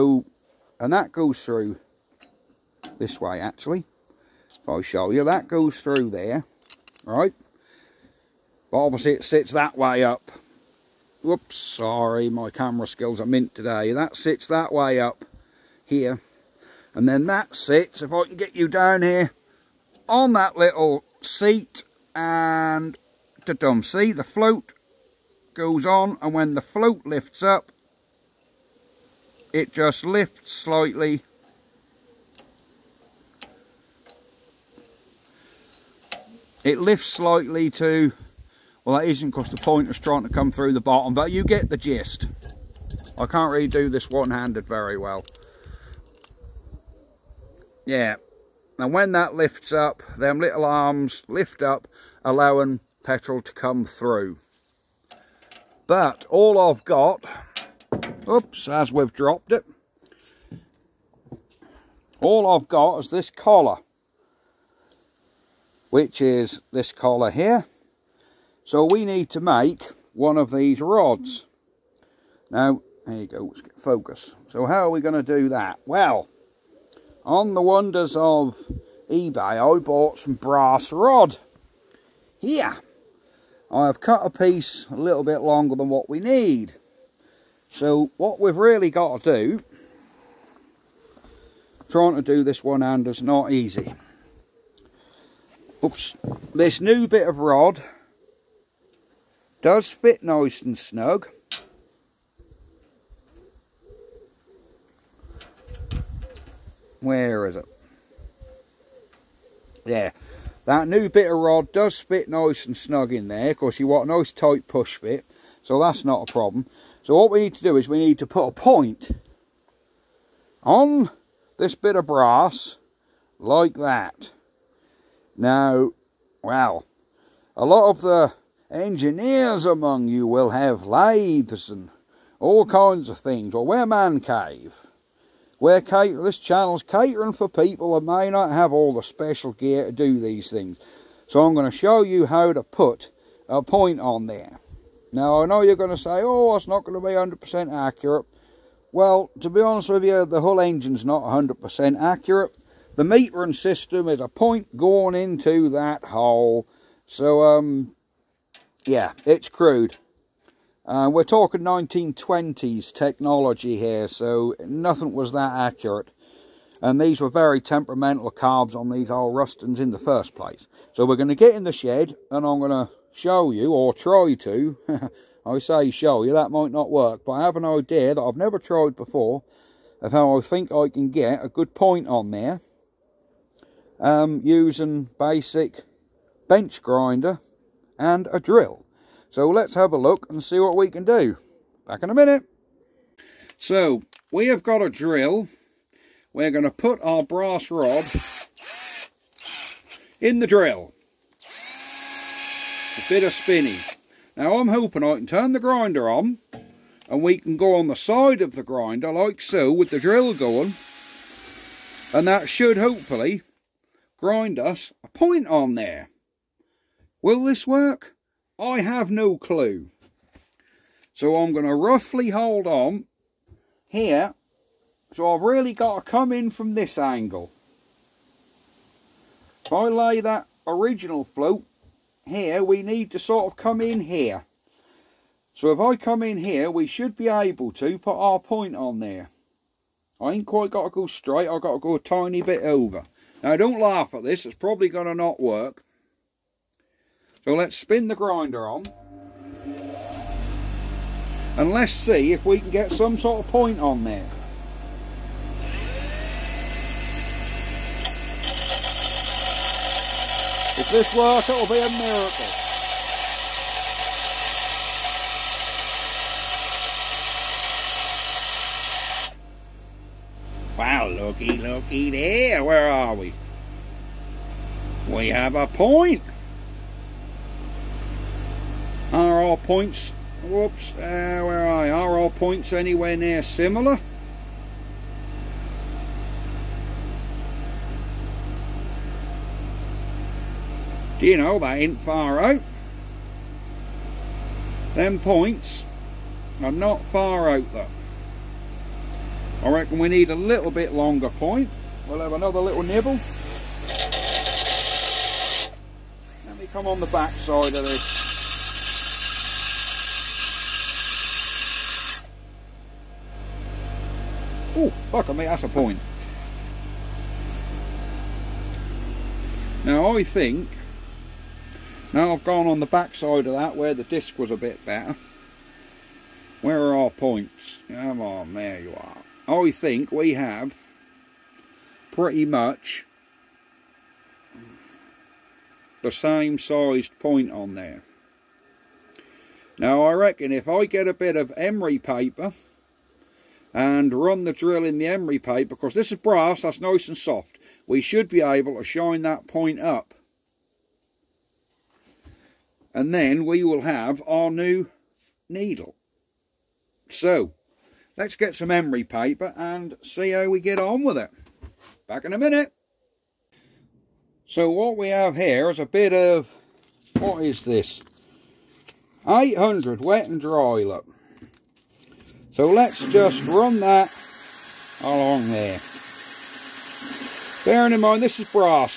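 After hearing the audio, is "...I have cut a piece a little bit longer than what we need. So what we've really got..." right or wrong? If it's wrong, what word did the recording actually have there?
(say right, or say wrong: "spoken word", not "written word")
right.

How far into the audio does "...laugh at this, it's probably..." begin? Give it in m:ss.
4:03.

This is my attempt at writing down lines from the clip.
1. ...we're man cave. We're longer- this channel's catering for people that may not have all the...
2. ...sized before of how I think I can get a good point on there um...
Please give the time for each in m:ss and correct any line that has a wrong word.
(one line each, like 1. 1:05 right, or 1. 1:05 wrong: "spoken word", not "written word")
1. 2:13 wrong: "cater", not "longer"
2. 2:58 wrong: "tried", not "sized".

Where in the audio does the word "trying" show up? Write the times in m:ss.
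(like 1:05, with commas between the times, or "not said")
0:39, 1:31.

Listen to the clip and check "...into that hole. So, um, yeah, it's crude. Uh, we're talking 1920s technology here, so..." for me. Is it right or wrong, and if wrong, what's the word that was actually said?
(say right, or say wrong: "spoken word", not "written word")
right.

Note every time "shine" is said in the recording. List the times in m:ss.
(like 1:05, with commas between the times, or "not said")
5:48.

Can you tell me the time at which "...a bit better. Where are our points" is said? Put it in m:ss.
5:24.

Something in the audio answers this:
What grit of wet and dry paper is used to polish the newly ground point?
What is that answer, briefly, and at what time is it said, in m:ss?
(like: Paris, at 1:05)
800, at 6:09.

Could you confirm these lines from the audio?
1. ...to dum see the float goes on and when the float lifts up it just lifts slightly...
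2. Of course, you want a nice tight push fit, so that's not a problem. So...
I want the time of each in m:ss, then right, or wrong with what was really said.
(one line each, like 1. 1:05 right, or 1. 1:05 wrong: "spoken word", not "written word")
1. 0:23 right
2. 1:53 right.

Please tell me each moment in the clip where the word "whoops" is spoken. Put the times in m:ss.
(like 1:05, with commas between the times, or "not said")
0:11, 4:40.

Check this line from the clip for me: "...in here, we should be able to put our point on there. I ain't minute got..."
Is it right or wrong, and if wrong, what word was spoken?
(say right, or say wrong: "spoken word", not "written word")
wrong: "quite", not "minute".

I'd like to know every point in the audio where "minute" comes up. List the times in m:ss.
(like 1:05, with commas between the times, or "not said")
3:12, 6:02.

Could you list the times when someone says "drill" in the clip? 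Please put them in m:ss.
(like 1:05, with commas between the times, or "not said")
3:08, 3:14, 3:20, 3:29, 5:44.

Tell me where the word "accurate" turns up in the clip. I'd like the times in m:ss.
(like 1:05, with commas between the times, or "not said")
2:27, 2:32, 2:45.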